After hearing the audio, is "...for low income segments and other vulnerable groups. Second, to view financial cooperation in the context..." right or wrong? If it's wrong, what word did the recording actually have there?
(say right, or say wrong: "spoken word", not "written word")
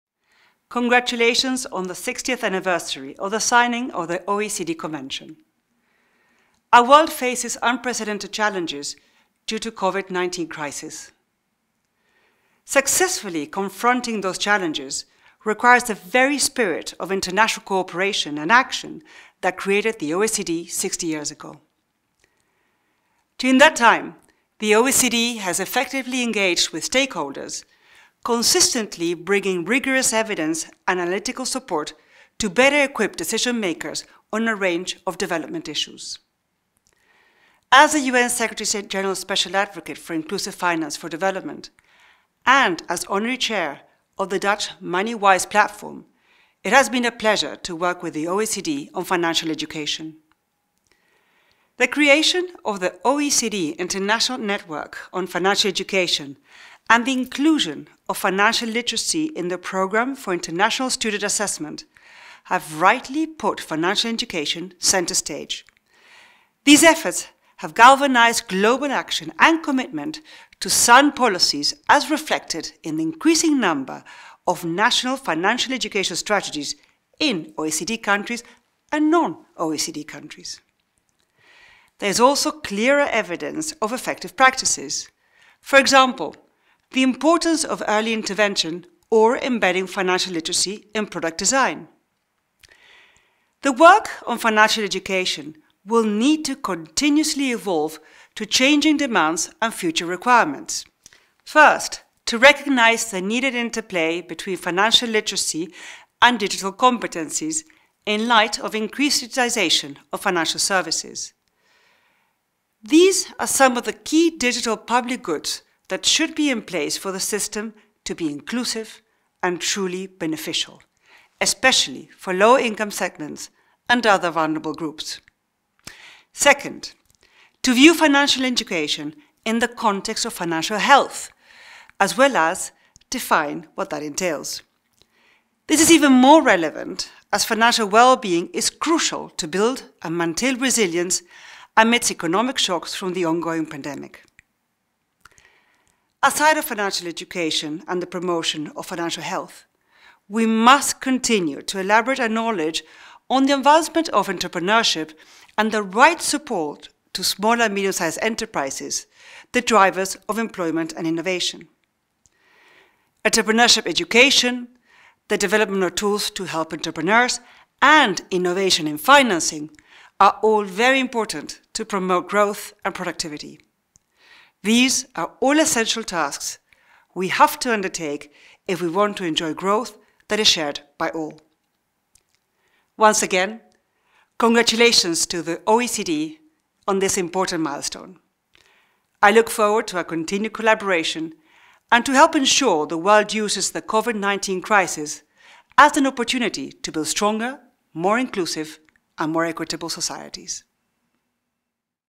wrong: "education", not "cooperation".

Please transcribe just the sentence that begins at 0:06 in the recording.
Our world faces unprecedented challenges due to COVID-19 crisis.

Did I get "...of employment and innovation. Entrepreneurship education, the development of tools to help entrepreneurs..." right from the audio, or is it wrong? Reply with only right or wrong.
right.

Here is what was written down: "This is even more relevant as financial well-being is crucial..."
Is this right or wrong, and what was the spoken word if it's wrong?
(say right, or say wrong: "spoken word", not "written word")
right.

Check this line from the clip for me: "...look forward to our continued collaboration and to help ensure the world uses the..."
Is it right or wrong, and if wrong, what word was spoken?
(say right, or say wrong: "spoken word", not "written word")
right.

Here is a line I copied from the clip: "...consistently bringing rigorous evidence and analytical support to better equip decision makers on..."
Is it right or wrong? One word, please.
right.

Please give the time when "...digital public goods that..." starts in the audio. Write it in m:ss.
1:54.